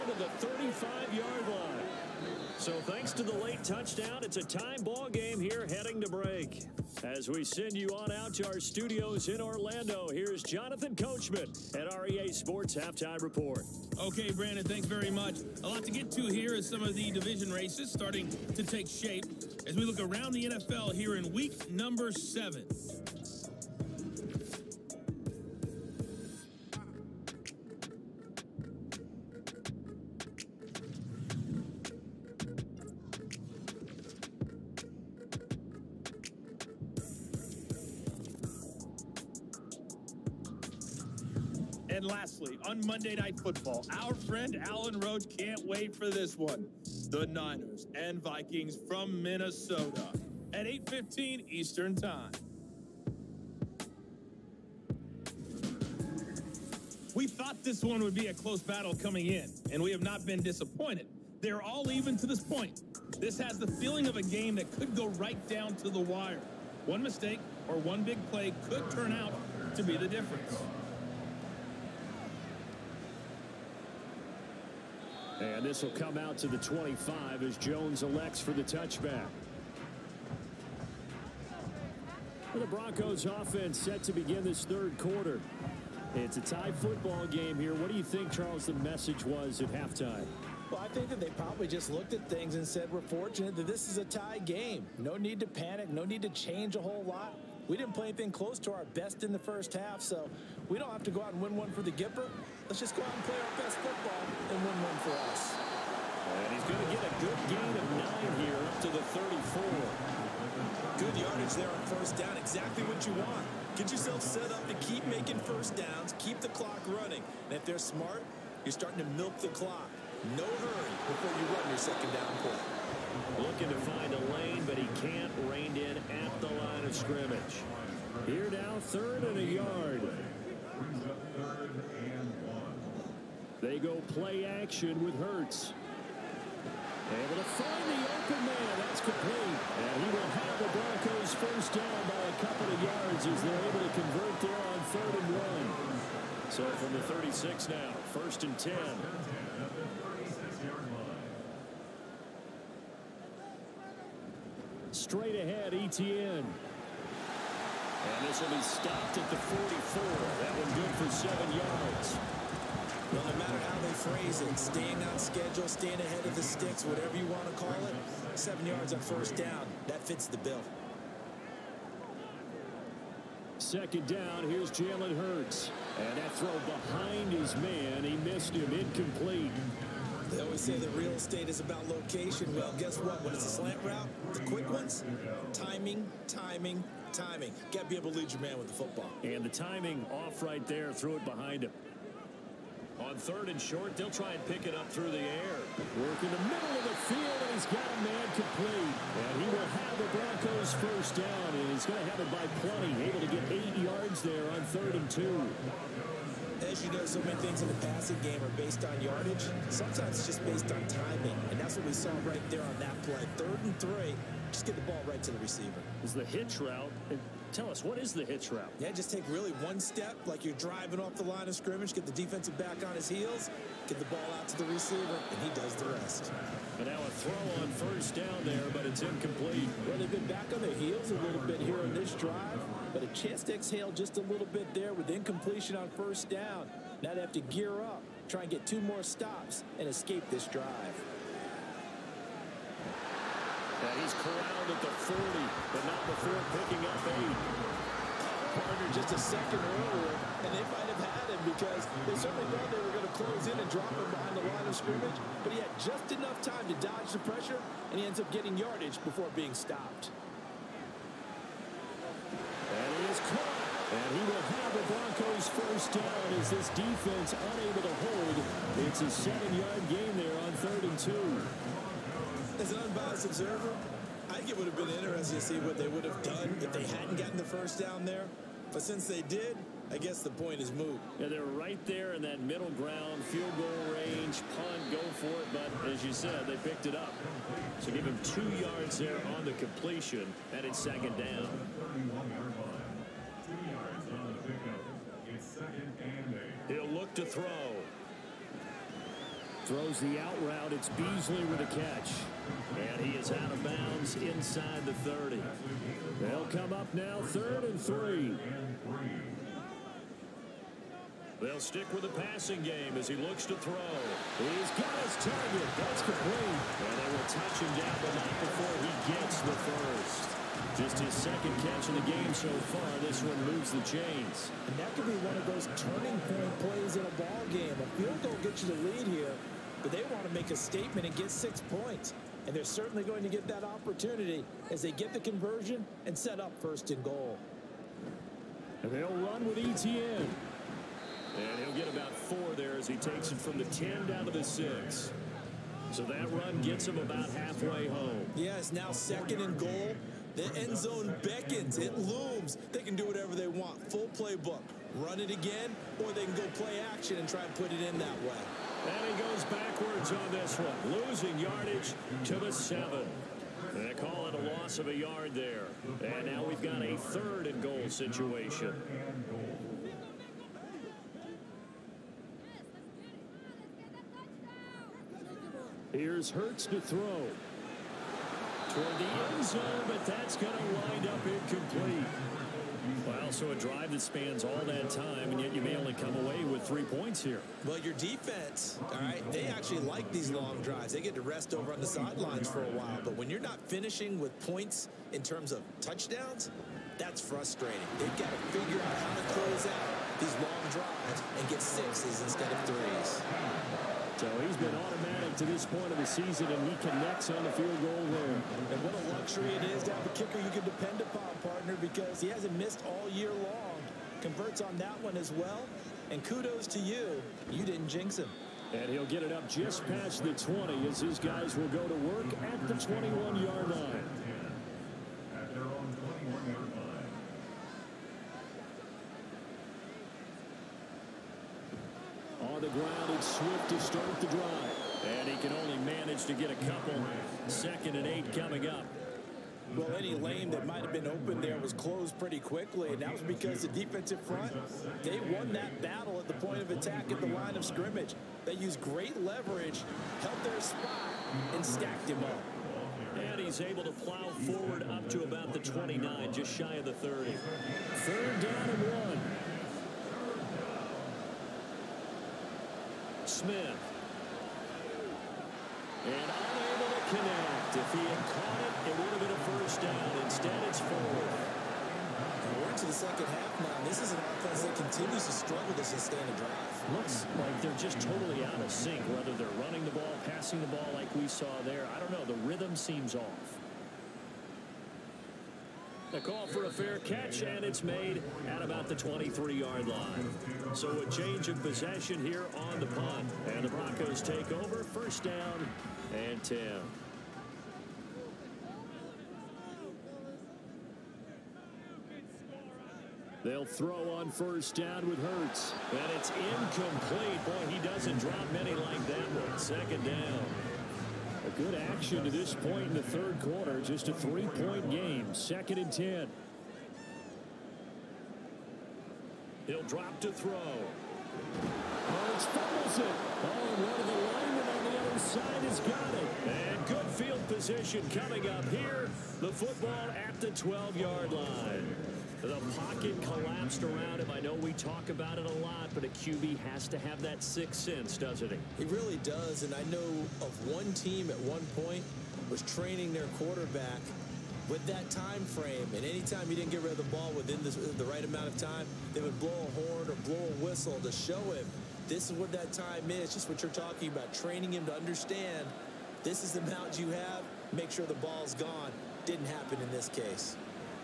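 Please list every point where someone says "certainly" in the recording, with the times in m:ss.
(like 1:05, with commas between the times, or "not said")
4:12, 5:32.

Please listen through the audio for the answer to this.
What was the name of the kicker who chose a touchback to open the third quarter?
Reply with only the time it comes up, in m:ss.
1:17.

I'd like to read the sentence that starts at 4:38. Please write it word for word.
But since they did, I guess the point is moot.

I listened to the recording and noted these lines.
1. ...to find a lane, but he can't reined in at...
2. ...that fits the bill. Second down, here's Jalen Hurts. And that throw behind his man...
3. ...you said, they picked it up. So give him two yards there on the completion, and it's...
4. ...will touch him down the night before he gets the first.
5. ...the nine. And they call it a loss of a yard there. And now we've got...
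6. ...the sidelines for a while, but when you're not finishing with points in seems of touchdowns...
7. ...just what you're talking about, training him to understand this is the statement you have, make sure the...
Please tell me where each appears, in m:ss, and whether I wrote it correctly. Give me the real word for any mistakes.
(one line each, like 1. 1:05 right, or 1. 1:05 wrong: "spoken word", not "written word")
1. 2:03 right
2. 2:49 right
3. 4:46 right
4. 5:17 right
5. 6:02 wrong: "seven", not "nine"
6. 6:31 wrong: "terms", not "seems"
7. 9:13 wrong: "amount", not "statement".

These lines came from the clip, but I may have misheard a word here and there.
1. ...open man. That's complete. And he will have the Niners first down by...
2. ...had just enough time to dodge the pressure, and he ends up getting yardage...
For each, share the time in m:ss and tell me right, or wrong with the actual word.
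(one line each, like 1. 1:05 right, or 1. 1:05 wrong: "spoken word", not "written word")
1. 2:18 wrong: "Broncos", not "Niners"
2. 4:15 right.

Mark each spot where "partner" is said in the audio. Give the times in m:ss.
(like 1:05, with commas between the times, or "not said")
4:08, 6:51.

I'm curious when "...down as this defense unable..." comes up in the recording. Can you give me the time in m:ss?
4:25.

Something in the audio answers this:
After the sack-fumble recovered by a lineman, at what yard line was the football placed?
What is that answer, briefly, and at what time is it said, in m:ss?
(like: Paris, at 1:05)
12-yard line, at 8:50.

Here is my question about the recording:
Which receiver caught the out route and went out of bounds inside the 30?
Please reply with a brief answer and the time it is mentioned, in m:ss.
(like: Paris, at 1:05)
Beasley, at 5:00.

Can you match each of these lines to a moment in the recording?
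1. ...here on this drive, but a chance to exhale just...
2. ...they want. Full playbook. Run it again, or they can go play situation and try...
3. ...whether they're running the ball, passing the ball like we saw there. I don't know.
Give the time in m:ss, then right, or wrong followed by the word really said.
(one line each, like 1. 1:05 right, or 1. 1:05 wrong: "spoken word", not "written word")
1. 3:51 right
2. 5:53 wrong: "action", not "situation"
3. 7:59 right.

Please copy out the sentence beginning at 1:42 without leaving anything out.
Let's just go out and play our best football and win one for us.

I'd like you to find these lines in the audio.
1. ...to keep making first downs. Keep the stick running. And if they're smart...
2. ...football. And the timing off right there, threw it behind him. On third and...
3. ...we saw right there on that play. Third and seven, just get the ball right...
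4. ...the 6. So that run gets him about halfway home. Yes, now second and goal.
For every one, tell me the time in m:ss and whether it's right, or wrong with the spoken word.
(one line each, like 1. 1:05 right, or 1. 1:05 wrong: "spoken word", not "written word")
1. 1:54 wrong: "clock", not "stick"
2. 3:08 right
3. 3:31 wrong: "three", not "seven"
4. 5:44 right.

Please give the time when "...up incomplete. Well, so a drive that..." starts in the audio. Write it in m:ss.
6:21.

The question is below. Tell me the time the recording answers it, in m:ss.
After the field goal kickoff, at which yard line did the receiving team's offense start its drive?
7:02.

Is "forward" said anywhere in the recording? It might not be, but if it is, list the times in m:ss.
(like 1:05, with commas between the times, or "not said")
7:34, 7:50.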